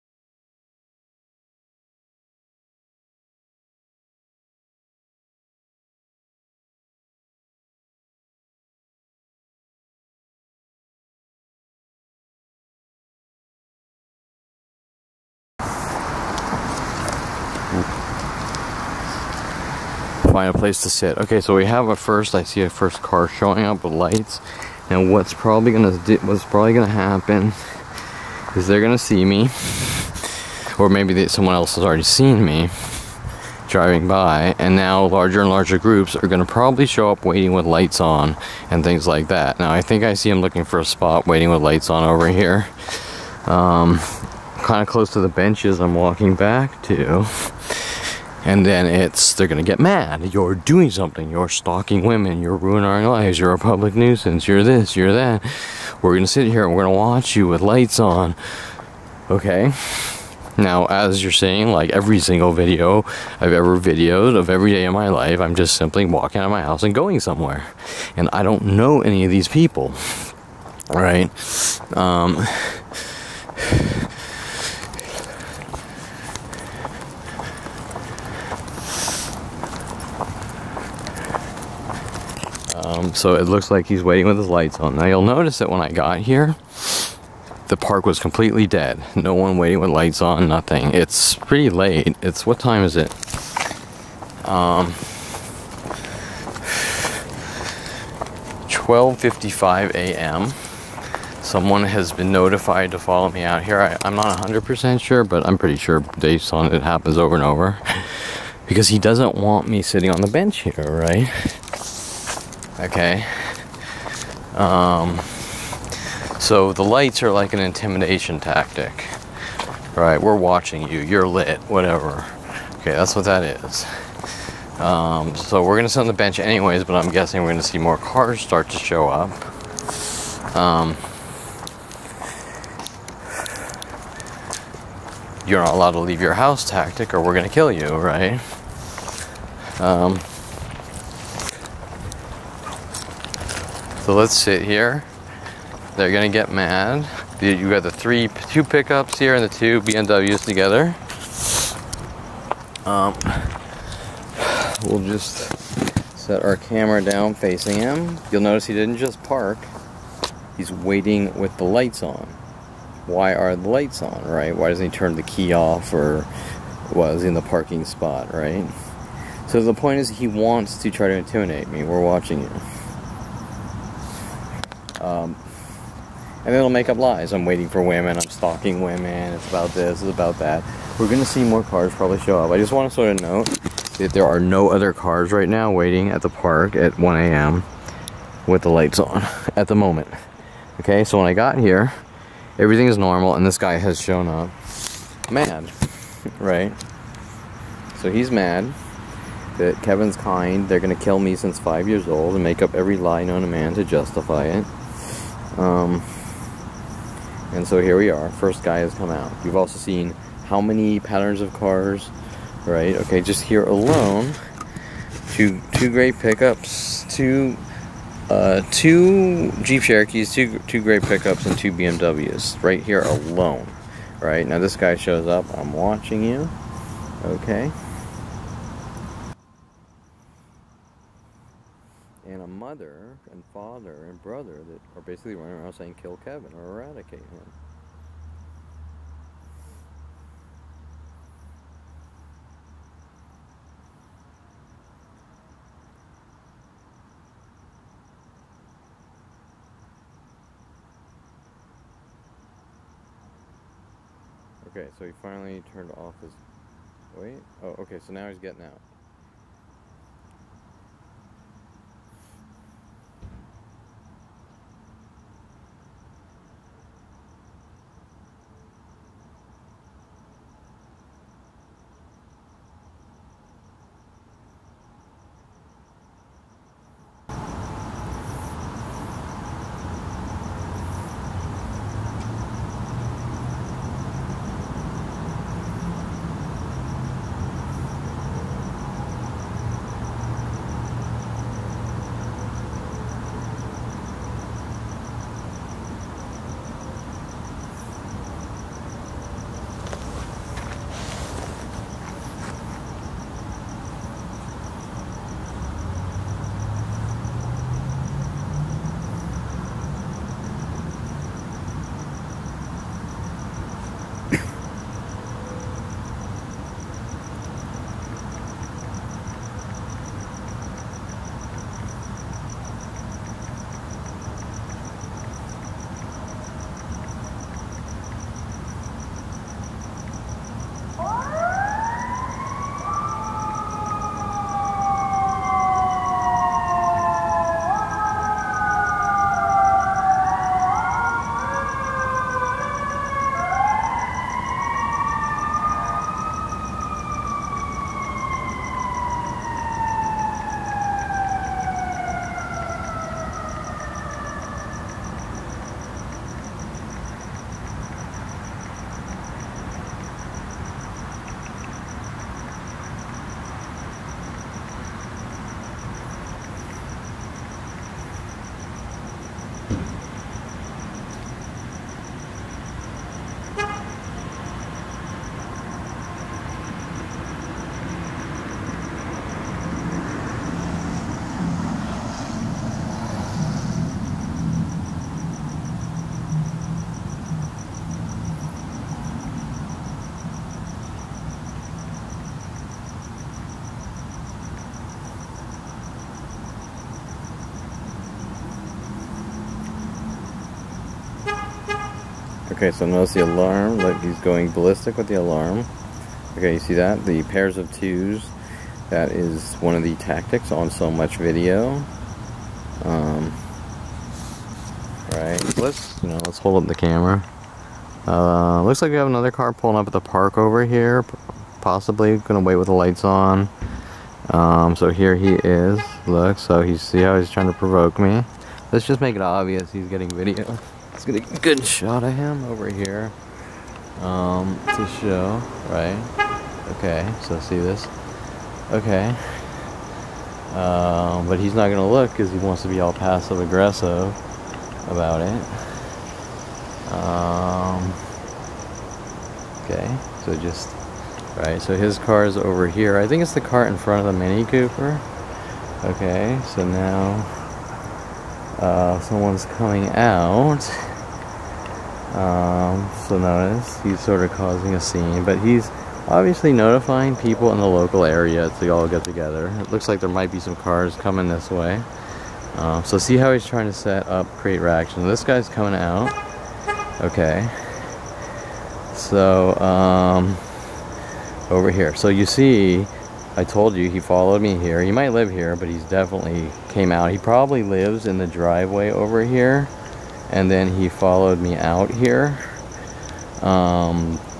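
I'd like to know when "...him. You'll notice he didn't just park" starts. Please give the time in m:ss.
2:37.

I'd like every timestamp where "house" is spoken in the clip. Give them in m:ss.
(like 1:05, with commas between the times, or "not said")
1:06, 2:16.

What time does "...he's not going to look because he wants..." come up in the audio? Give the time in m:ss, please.
7:21.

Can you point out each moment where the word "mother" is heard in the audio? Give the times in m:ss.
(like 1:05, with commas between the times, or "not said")
3:52.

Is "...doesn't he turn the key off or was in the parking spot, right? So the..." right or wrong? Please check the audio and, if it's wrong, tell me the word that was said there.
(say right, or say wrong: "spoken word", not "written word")
right.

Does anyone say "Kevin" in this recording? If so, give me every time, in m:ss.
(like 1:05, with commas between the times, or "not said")
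3:19, 3:56.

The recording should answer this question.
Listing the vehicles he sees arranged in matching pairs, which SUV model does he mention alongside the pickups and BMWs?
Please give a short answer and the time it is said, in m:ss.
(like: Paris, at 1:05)
Jeep Cherokees, at 3:39.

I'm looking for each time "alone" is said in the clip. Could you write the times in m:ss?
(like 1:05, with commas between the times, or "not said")
3:33, 3:43.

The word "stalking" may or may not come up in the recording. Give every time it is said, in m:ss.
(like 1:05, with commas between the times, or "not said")
0:51, 2:58.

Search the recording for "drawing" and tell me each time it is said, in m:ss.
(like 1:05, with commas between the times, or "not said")
not said.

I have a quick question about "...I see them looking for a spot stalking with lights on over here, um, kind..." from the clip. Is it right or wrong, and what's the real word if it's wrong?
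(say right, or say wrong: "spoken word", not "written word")
wrong: "waiting", not "stalking".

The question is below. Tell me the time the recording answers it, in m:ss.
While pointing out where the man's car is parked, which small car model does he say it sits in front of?
7:34.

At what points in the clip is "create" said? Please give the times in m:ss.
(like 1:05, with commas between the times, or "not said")
7:54.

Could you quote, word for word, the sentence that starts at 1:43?
I, am not 100% sure, but I'm pretty sure based on it happens over and over.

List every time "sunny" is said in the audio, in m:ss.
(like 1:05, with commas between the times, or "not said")
not said.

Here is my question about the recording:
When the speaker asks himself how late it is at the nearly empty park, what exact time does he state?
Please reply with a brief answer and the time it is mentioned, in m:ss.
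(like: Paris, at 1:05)
12:55 a.m., at 1:38.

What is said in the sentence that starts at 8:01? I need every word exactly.
So you see, I told you he followed me here.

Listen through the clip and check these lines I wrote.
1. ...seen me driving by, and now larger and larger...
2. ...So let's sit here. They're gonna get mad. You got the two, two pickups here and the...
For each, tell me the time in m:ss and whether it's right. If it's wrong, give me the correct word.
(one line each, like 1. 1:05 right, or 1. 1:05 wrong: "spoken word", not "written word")
1. 0:32 right
2. 2:24 wrong: "three", not "two".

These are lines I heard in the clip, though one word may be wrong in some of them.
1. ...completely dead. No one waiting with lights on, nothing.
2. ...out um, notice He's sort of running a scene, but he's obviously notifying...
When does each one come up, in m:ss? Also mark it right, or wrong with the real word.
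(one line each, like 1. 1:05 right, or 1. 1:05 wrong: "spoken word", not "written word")
1. 1:28 right
2. 7:39 wrong: "causing", not "running".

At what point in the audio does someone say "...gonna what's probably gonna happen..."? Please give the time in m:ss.
0:25.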